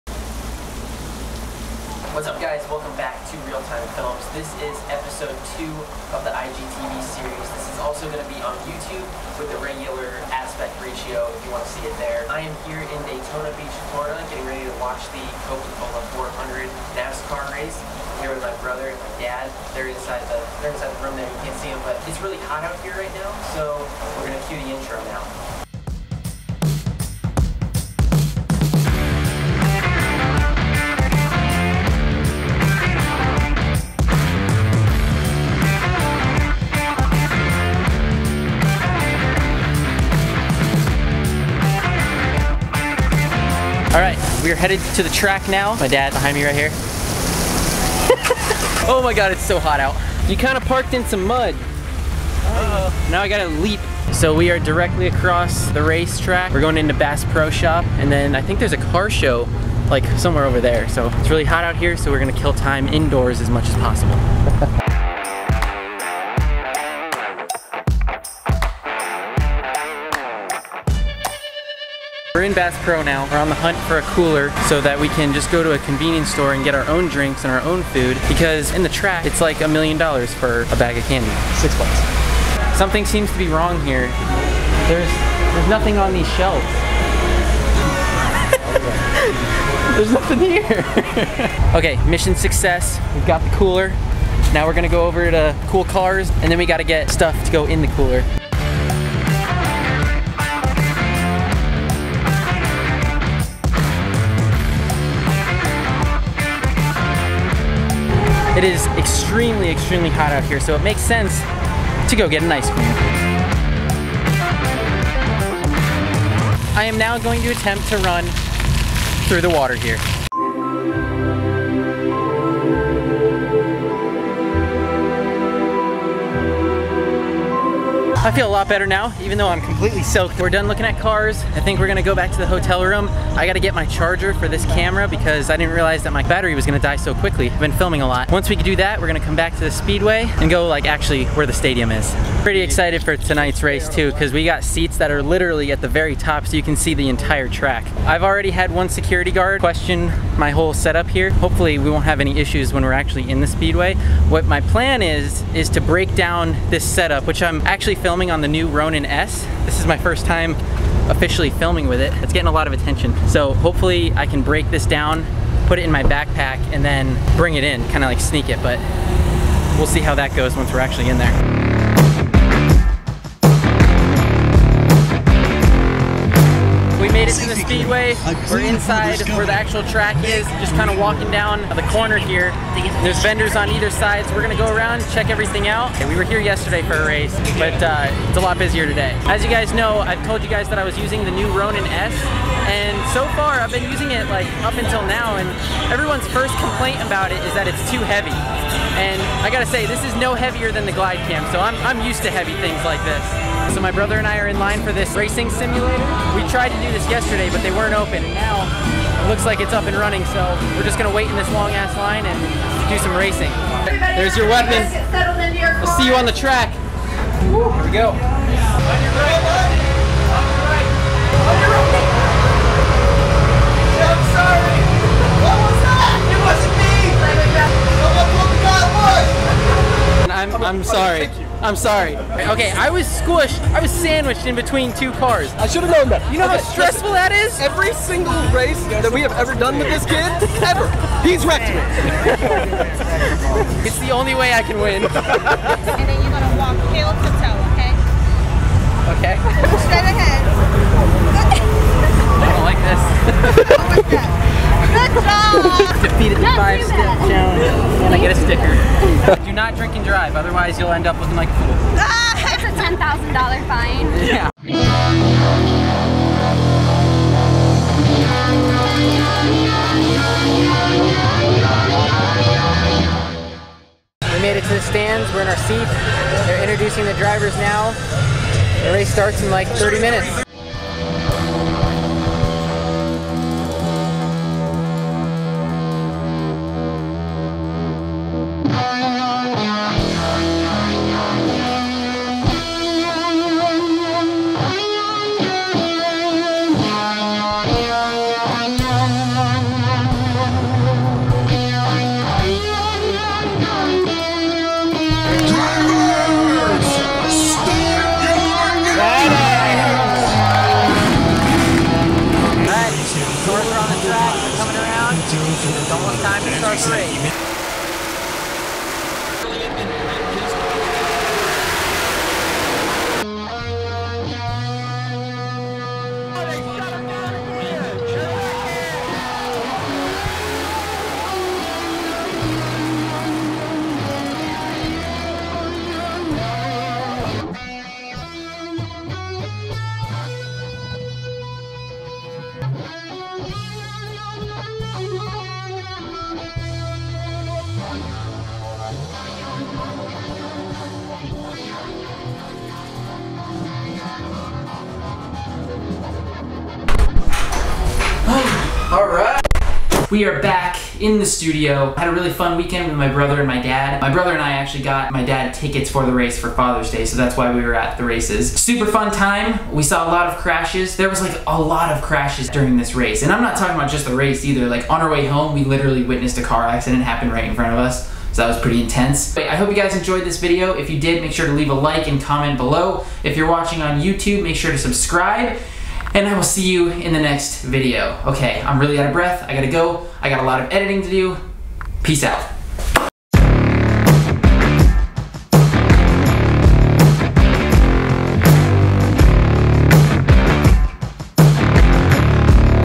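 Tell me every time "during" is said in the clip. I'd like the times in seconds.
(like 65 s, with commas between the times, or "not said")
372 s.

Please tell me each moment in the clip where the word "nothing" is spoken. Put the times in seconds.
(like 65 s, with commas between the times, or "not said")
85 s, 90 s.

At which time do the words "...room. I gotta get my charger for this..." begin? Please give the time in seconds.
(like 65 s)
132 s.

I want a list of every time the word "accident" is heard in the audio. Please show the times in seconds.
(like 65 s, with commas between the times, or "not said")
376 s.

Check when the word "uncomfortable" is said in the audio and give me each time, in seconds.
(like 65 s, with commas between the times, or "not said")
not said.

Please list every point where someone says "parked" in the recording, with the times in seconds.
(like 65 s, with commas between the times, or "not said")
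50 s.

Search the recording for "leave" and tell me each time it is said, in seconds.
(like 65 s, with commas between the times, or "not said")
381 s.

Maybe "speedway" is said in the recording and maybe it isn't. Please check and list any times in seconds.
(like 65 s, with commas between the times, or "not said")
139 s, 153 s, 177 s.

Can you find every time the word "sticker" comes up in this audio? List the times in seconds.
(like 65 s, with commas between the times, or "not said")
258 s.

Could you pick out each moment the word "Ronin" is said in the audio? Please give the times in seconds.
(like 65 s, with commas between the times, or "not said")
158 s, 191 s.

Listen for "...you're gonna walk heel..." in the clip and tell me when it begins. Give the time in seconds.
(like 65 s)
246 s.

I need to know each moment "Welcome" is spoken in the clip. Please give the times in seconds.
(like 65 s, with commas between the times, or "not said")
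2 s.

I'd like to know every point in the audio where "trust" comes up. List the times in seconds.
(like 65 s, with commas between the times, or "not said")
not said.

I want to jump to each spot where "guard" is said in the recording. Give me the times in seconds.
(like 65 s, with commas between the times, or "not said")
149 s.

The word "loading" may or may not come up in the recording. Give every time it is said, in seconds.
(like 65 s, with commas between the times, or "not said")
not said.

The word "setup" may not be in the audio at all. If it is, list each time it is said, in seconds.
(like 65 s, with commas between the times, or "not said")
150 s, 156 s.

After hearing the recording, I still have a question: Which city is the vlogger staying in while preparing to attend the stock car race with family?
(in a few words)
Daytona Beach.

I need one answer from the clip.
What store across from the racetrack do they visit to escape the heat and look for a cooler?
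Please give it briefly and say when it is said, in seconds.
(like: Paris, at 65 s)
Bass Pro Shop, at 56 s.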